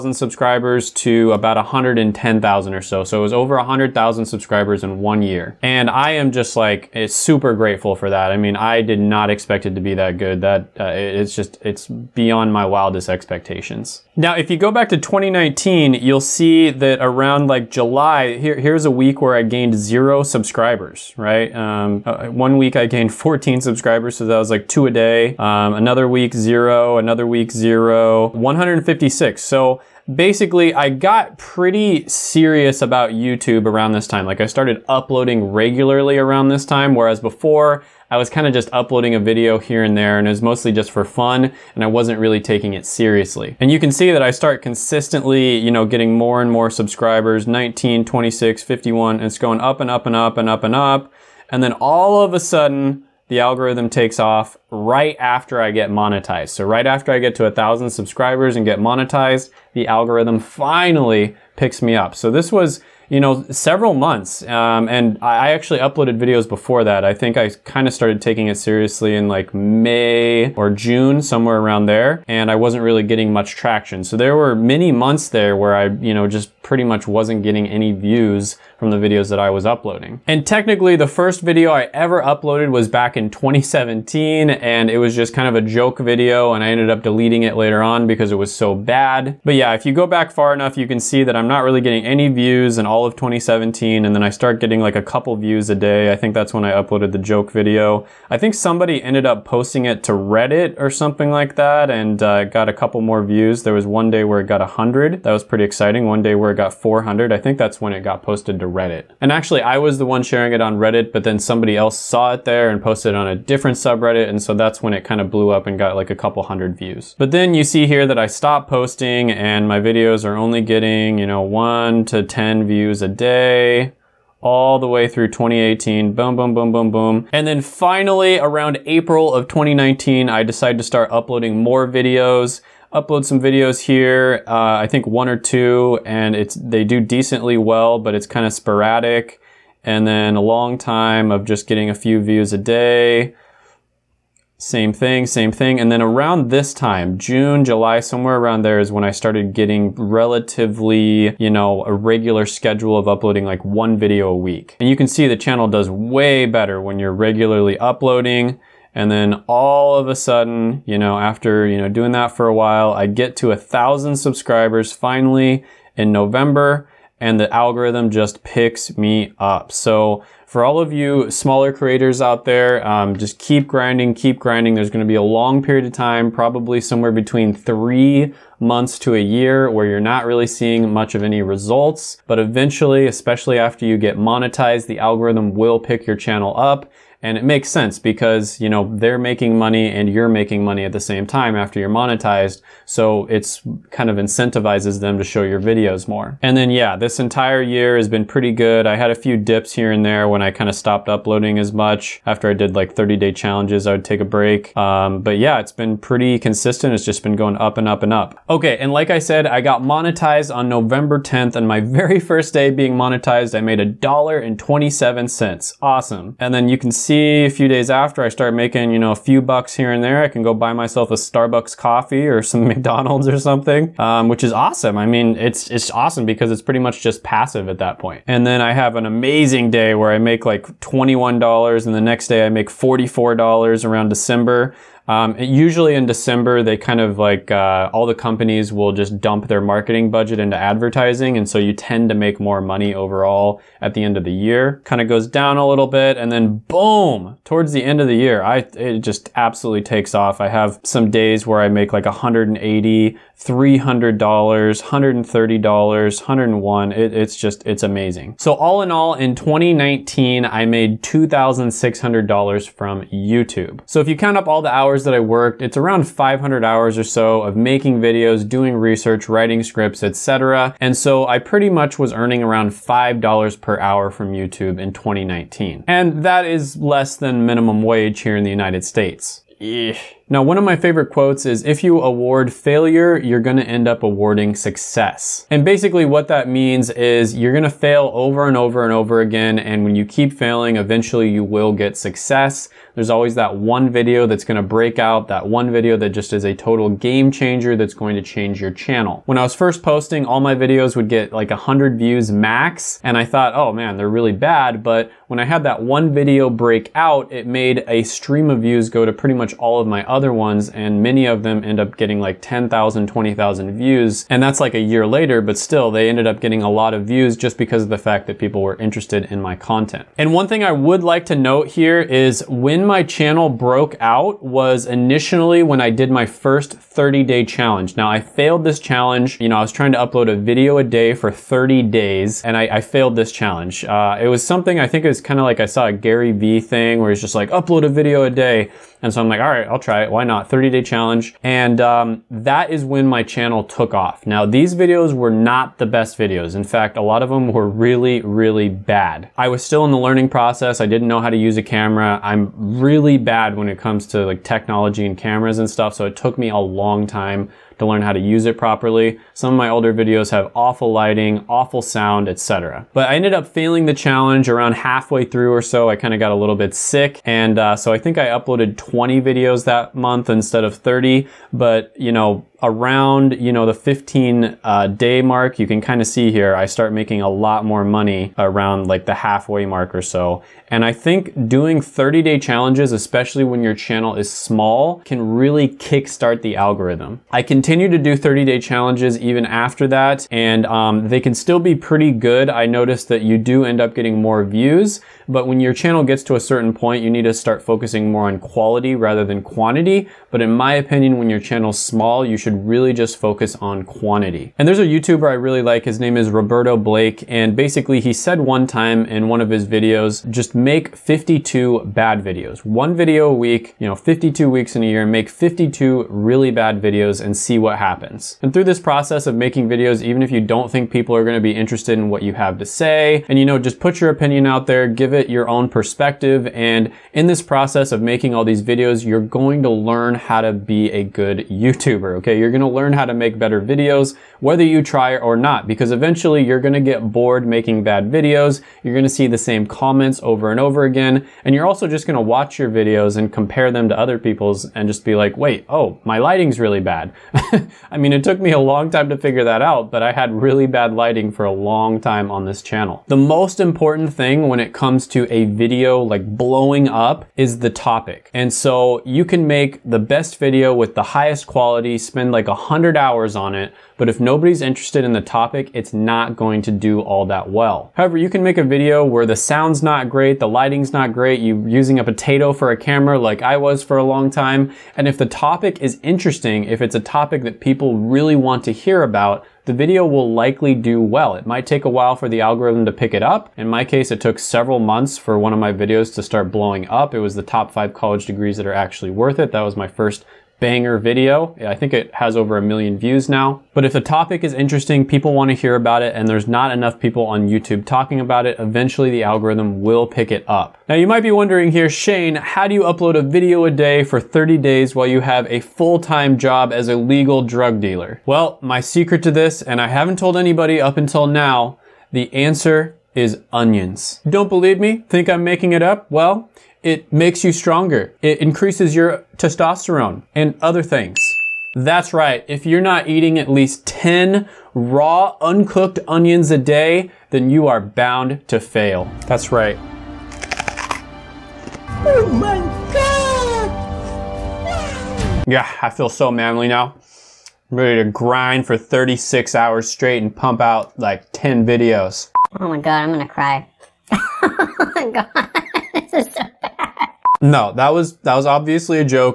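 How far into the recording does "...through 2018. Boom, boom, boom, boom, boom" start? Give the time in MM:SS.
02:05.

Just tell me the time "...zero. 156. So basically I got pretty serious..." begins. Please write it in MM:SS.
00:27.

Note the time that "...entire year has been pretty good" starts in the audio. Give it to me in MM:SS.
03:17.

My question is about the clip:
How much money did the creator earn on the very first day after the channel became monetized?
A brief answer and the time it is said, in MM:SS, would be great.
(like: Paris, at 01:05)
$1.27, at 03:33.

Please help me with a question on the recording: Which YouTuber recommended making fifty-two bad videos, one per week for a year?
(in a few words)
Roberto Blake.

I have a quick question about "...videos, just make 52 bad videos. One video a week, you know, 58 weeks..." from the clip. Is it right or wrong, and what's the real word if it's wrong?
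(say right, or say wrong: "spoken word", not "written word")
wrong: "52", not "58".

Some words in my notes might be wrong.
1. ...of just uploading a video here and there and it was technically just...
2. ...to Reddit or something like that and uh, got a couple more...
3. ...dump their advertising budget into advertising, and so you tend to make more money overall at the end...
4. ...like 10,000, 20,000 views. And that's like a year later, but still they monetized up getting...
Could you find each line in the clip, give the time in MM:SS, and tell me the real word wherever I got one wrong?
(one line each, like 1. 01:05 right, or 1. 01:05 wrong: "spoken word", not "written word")
1. 00:38 wrong: "mostly", not "technically"
2. 01:40 right
3. 03:59 wrong: "marketing", not "advertising"
4. 05:12 wrong: "ended", not "monetized".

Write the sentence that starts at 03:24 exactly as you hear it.
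Um, but yeah, it's been pretty consistent.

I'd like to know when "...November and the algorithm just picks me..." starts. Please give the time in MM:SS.
02:46.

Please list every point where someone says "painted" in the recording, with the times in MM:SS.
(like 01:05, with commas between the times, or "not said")
not said.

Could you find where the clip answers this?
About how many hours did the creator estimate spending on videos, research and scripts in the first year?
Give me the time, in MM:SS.
04:26.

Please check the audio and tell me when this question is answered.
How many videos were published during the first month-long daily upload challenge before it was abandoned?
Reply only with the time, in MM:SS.
06:08.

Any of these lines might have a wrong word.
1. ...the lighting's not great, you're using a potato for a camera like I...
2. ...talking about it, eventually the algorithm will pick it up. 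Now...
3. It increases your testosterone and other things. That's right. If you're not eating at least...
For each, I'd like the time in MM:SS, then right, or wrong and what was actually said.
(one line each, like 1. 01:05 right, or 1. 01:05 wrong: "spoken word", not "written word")
1. 07:50 right
2. 08:17 right
3. 08:38 right.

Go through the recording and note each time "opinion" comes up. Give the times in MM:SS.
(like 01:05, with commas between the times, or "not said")
06:40, 07:04.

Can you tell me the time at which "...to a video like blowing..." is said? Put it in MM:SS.
07:35.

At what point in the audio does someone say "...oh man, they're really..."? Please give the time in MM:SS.
05:03.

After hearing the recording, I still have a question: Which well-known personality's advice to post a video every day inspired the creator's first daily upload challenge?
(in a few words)
Gary Vee.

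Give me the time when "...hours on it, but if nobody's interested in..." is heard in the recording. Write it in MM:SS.
07:42.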